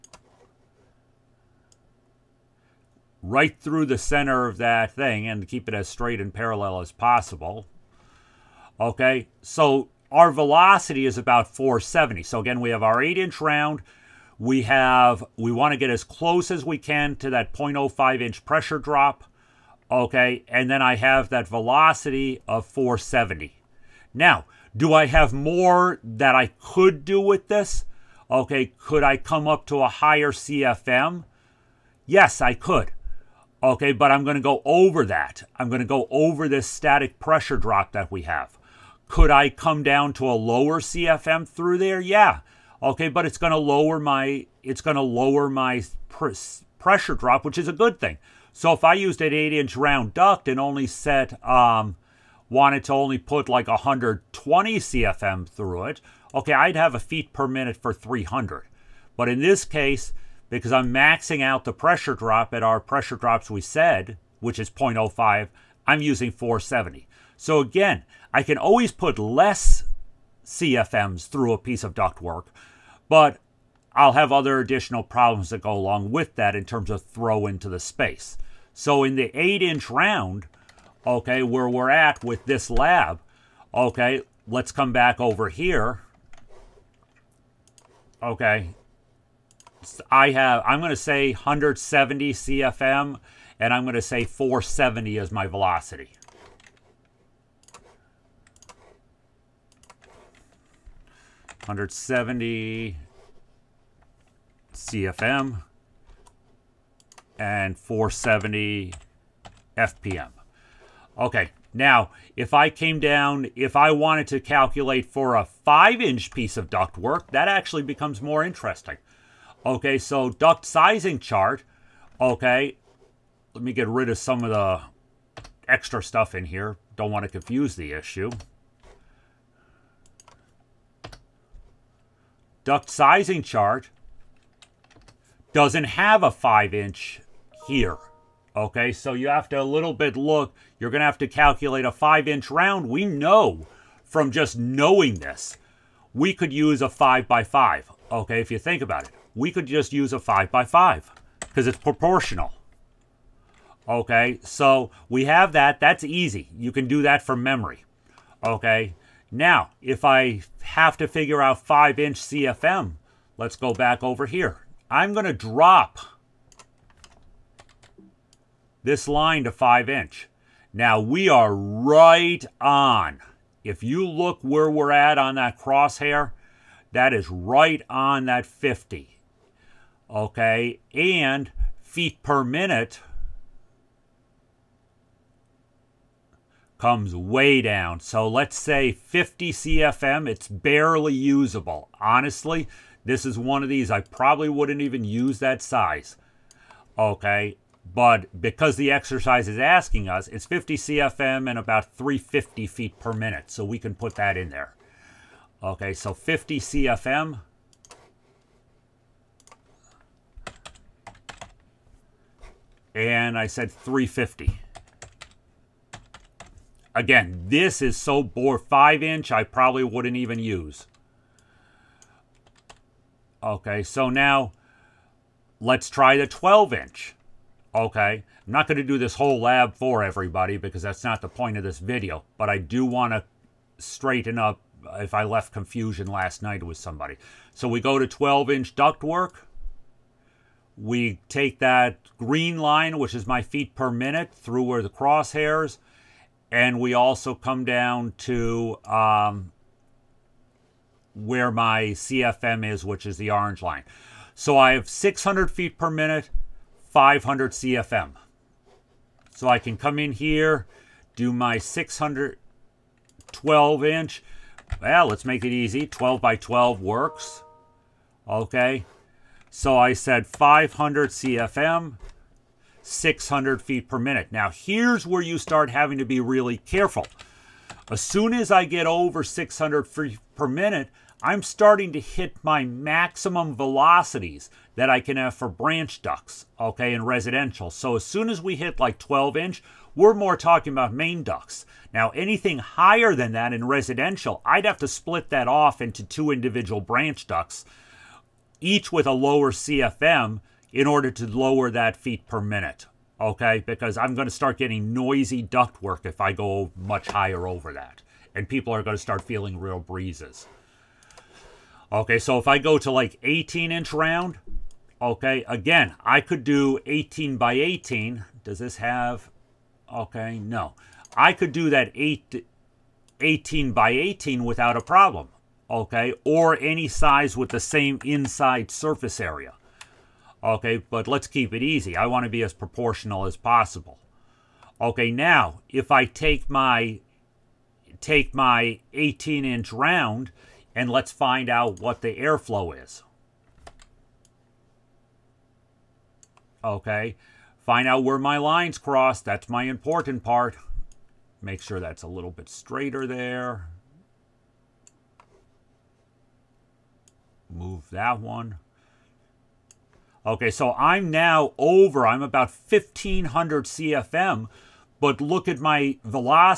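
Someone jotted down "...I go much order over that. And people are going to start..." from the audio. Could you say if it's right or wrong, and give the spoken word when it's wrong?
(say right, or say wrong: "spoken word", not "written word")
wrong: "higher", not "order".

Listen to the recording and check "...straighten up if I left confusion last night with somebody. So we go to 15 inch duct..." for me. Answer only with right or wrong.
wrong.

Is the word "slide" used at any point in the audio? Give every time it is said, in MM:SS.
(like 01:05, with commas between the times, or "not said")
not said.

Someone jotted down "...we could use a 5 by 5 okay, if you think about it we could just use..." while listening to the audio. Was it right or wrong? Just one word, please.
right.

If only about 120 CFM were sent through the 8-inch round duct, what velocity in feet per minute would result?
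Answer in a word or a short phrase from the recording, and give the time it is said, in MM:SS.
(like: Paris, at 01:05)
300, at 00:57.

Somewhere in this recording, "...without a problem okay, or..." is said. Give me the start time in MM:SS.
05:24.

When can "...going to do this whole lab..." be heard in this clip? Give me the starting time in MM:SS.
03:48.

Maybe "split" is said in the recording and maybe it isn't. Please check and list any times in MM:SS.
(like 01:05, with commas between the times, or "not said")
04:54.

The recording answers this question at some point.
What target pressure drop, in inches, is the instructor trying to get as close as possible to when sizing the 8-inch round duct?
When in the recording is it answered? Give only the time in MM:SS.
00:17.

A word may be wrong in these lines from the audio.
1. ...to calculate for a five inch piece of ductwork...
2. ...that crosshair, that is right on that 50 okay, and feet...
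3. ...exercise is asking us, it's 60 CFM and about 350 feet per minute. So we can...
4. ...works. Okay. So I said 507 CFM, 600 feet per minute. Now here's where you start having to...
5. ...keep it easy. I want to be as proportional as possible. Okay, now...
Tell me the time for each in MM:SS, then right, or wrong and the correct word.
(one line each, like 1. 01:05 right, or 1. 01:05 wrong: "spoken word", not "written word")
1. 01:54 right
2. 02:55 right
3. 03:18 wrong: "50", not "60"
4. 04:26 wrong: "500", not "507"
5. 05:31 right.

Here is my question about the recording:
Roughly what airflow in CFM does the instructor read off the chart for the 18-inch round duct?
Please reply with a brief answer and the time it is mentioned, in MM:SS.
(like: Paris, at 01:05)
1,500 CFM, at 06:02.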